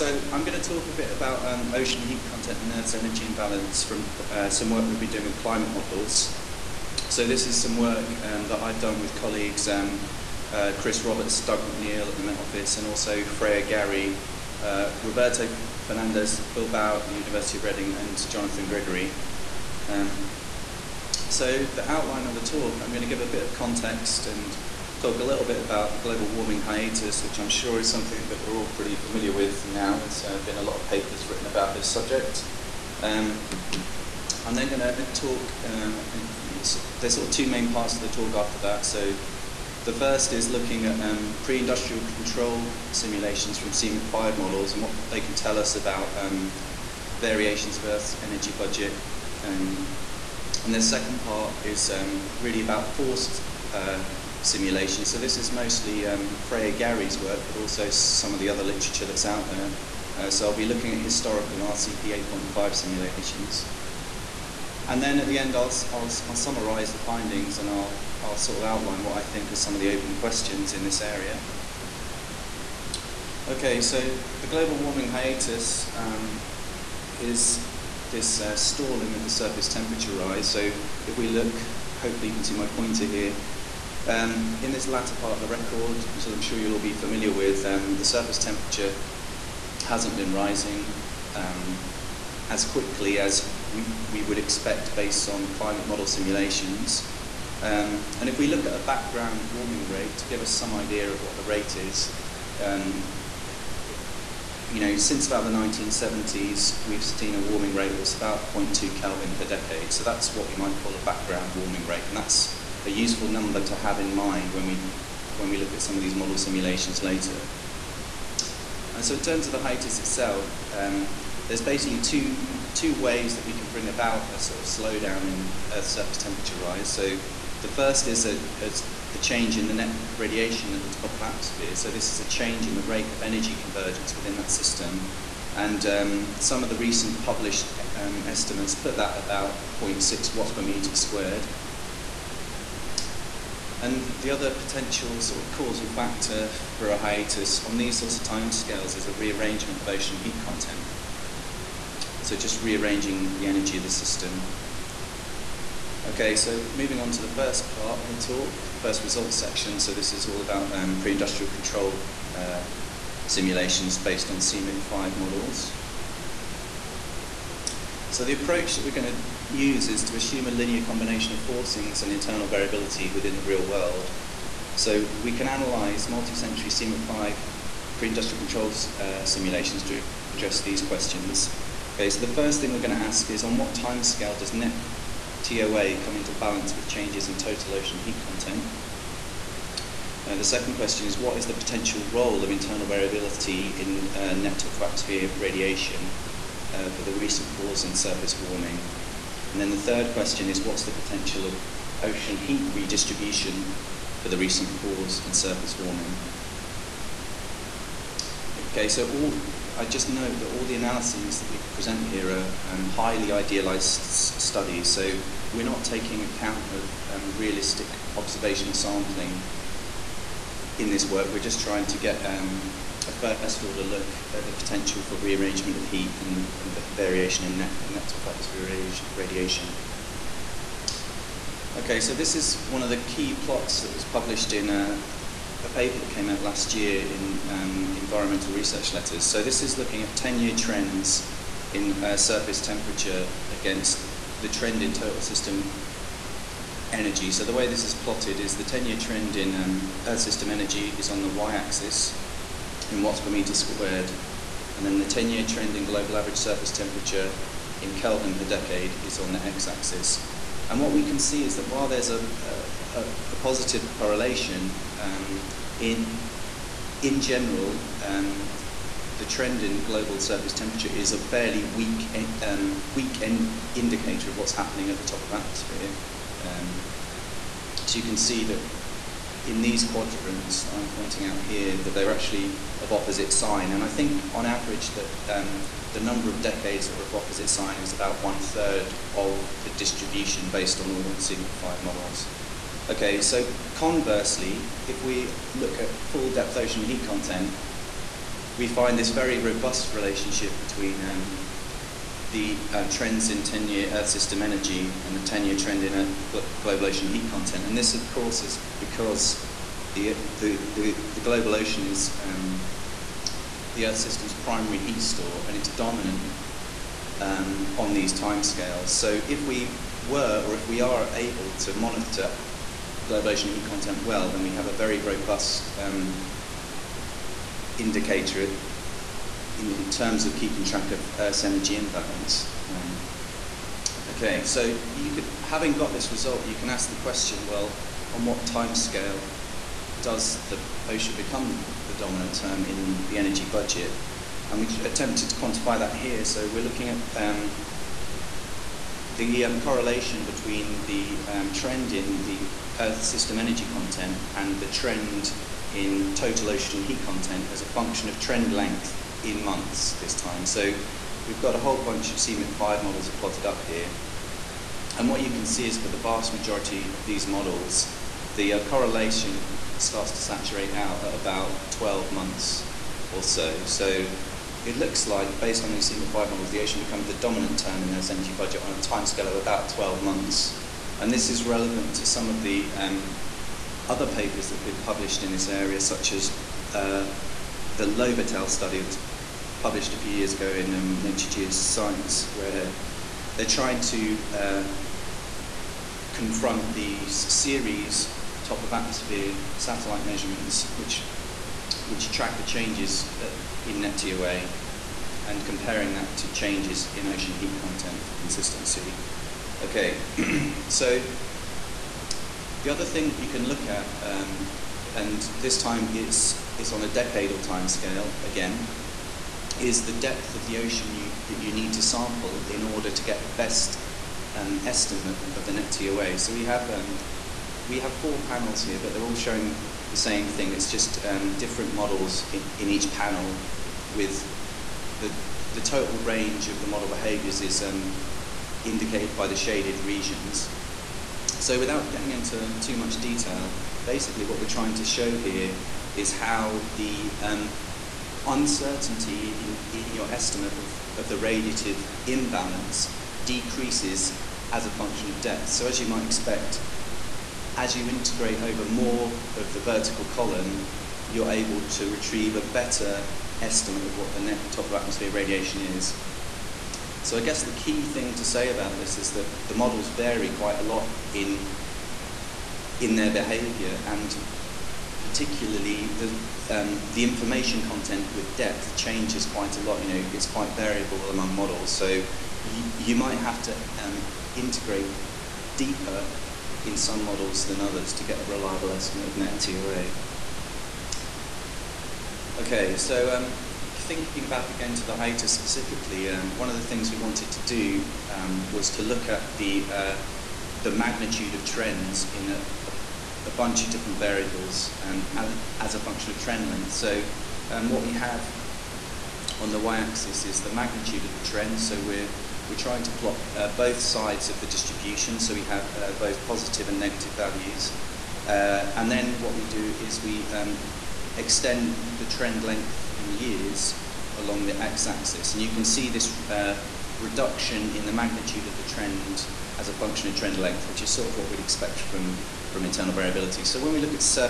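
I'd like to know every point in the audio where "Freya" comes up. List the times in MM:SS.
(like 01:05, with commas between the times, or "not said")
00:13, 00:56.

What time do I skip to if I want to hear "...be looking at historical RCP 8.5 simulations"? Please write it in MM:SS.
01:00.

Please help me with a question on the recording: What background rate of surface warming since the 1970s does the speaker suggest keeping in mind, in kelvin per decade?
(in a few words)
0.2.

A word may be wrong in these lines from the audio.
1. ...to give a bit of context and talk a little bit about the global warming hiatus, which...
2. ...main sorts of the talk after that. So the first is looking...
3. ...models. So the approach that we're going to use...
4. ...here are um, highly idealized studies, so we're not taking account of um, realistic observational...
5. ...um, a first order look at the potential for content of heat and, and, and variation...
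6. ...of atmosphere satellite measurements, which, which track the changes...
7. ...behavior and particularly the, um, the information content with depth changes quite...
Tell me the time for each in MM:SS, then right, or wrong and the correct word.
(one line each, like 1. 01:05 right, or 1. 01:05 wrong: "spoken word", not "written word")
1. 00:23 right
2. 00:37 wrong: "parts", not "sorts"
3. 02:45 right
4. 03:32 right
5. 03:42 wrong: "rearrangement", not "content"
6. 06:38 right
7. 07:53 right.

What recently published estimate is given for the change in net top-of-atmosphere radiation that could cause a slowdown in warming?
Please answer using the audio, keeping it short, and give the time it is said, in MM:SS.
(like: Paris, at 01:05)
0.6 watts per square meter, at 02:19.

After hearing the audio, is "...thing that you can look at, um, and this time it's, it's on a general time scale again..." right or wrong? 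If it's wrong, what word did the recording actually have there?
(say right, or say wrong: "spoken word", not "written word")
wrong: "decadal", not "general".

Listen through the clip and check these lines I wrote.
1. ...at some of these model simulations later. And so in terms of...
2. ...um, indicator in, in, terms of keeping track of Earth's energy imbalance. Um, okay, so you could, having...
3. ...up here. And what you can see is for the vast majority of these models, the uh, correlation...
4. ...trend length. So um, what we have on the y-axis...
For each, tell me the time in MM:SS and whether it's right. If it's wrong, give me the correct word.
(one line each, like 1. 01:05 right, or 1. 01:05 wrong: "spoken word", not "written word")
1. 01:55 right
2. 05:25 right
3. 06:03 right
4. 08:26 right.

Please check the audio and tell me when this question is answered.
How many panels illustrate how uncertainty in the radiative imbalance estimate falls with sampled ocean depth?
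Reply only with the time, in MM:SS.
07:07.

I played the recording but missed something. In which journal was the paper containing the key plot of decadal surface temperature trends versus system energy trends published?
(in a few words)
Environmental Research Letters.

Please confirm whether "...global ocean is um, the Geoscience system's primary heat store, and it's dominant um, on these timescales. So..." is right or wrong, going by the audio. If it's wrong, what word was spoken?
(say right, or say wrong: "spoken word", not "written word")
wrong: "Earth", not "Geoscience".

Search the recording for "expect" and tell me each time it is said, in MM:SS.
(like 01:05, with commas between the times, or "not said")
01:34, 07:36, 08:51.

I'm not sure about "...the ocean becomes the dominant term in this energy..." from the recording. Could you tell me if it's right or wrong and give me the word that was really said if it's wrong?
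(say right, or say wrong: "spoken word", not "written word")
right.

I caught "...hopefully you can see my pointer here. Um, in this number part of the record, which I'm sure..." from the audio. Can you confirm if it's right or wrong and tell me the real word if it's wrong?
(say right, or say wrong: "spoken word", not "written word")
wrong: "latter", not "number".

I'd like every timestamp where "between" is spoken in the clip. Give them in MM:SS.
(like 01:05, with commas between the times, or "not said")
05:00, 05:50.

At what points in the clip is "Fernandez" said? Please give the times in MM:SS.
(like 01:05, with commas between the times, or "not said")
00:15.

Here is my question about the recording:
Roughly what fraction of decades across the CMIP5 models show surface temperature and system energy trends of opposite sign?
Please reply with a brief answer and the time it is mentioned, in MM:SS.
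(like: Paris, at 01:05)
One third, at 04:48.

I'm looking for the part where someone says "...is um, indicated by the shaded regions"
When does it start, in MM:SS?
07:17.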